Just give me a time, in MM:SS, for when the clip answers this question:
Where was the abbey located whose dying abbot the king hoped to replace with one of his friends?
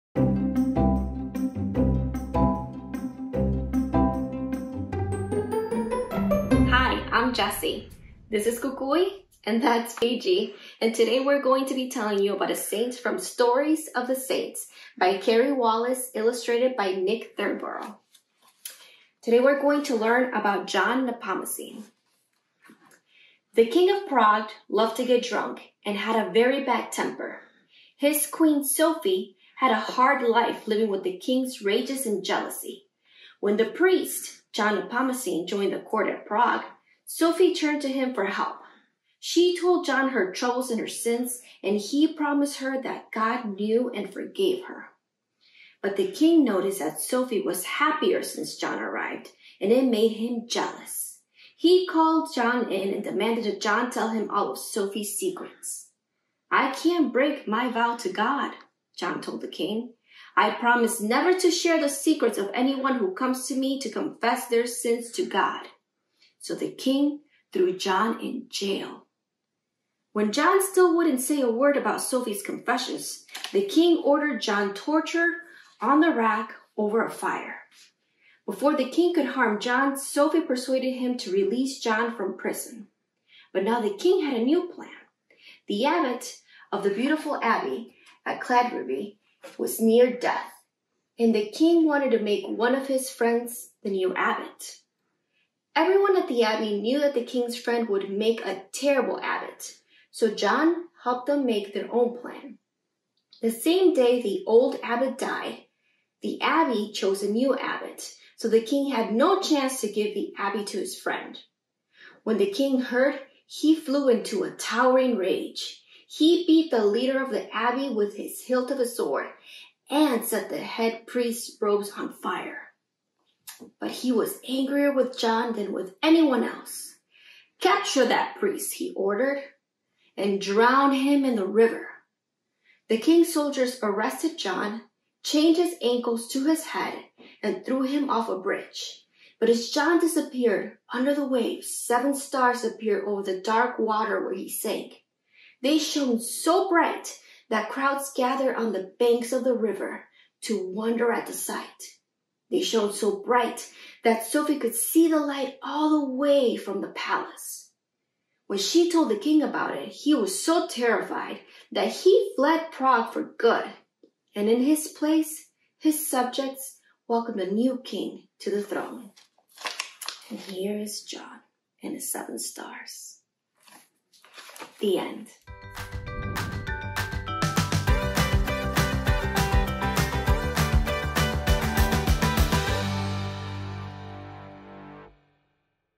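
01:28.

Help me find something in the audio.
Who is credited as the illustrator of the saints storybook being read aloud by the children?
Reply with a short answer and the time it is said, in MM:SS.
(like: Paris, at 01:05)
Nick Thornborough, at 00:16.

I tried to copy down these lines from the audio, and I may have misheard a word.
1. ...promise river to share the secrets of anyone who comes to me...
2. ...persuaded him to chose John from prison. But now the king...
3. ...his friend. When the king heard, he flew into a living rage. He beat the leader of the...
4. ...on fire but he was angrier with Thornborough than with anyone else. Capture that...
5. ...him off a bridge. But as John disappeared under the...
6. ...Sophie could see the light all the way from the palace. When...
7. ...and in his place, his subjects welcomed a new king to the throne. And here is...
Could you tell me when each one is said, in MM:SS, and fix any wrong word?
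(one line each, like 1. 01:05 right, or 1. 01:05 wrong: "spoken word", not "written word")
1. 01:00 wrong: "never", not "river"
2. 01:20 wrong: "release", not "chose"
3. 01:50 wrong: "towering", not "living"
4. 02:01 wrong: "John", not "Thornborough"
5. 02:17 right
6. 02:34 right
7. 02:44 right.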